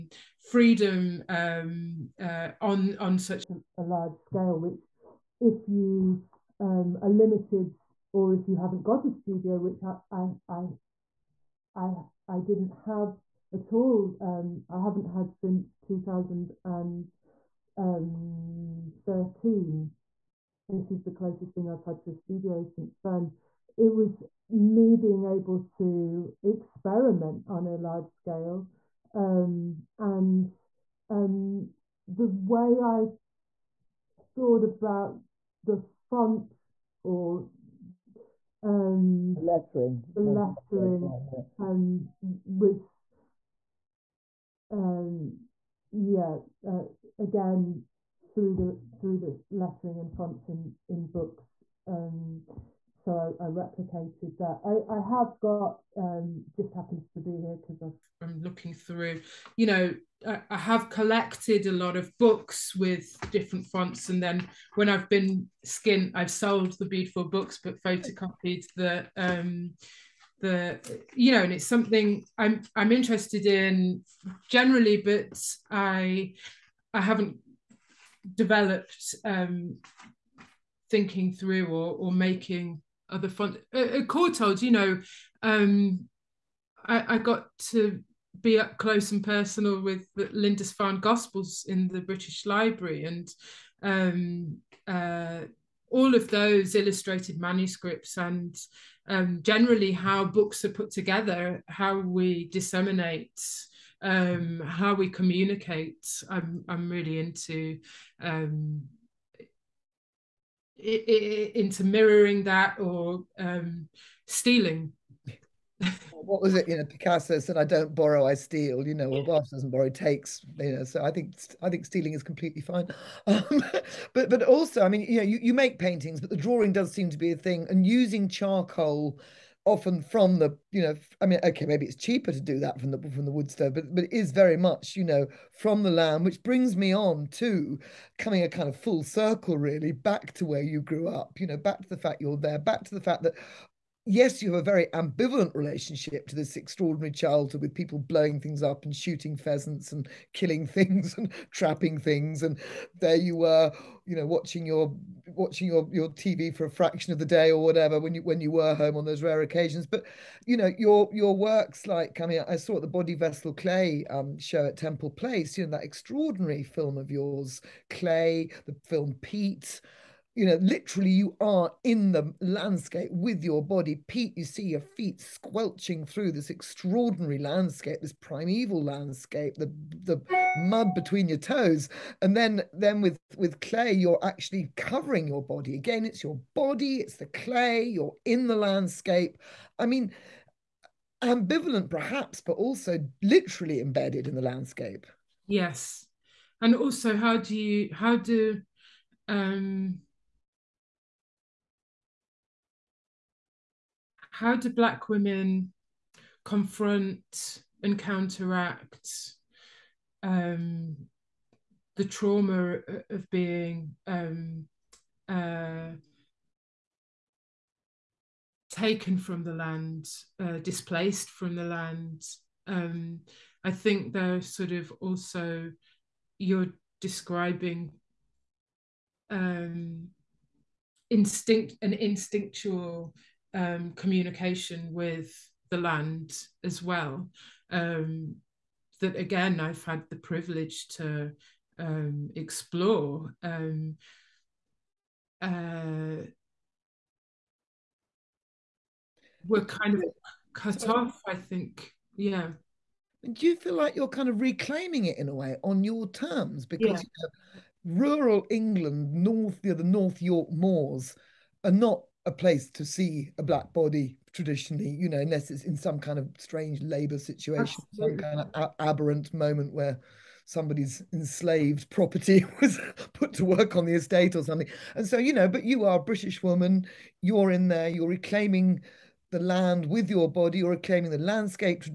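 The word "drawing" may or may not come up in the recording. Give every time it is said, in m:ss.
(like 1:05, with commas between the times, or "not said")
2:06.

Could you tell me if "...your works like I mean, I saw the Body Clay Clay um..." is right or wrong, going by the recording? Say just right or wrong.
wrong.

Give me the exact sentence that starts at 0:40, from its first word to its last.
The lettering um, was, um, yeah, uh, again through the through the lettering and fonts in in books.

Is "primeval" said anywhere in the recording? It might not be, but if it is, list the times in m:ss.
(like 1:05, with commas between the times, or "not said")
2:58.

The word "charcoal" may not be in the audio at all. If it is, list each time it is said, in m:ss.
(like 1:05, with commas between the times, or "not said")
2:08.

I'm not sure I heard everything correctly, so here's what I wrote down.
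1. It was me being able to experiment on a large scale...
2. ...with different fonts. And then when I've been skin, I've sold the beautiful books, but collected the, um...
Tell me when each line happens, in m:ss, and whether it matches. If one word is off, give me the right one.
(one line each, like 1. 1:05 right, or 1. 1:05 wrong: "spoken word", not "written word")
1. 0:23 right
2. 1:02 wrong: "photocopied", not "collected".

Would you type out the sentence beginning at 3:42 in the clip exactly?
Um, I think they're sort of also you're describing um, instinct an instinctual um, communication with the land as well.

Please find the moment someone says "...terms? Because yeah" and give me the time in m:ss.
4:16.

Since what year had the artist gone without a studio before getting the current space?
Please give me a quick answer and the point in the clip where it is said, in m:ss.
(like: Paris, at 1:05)
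2013, at 0:15.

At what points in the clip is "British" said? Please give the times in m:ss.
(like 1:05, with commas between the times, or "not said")
1:32, 4:36.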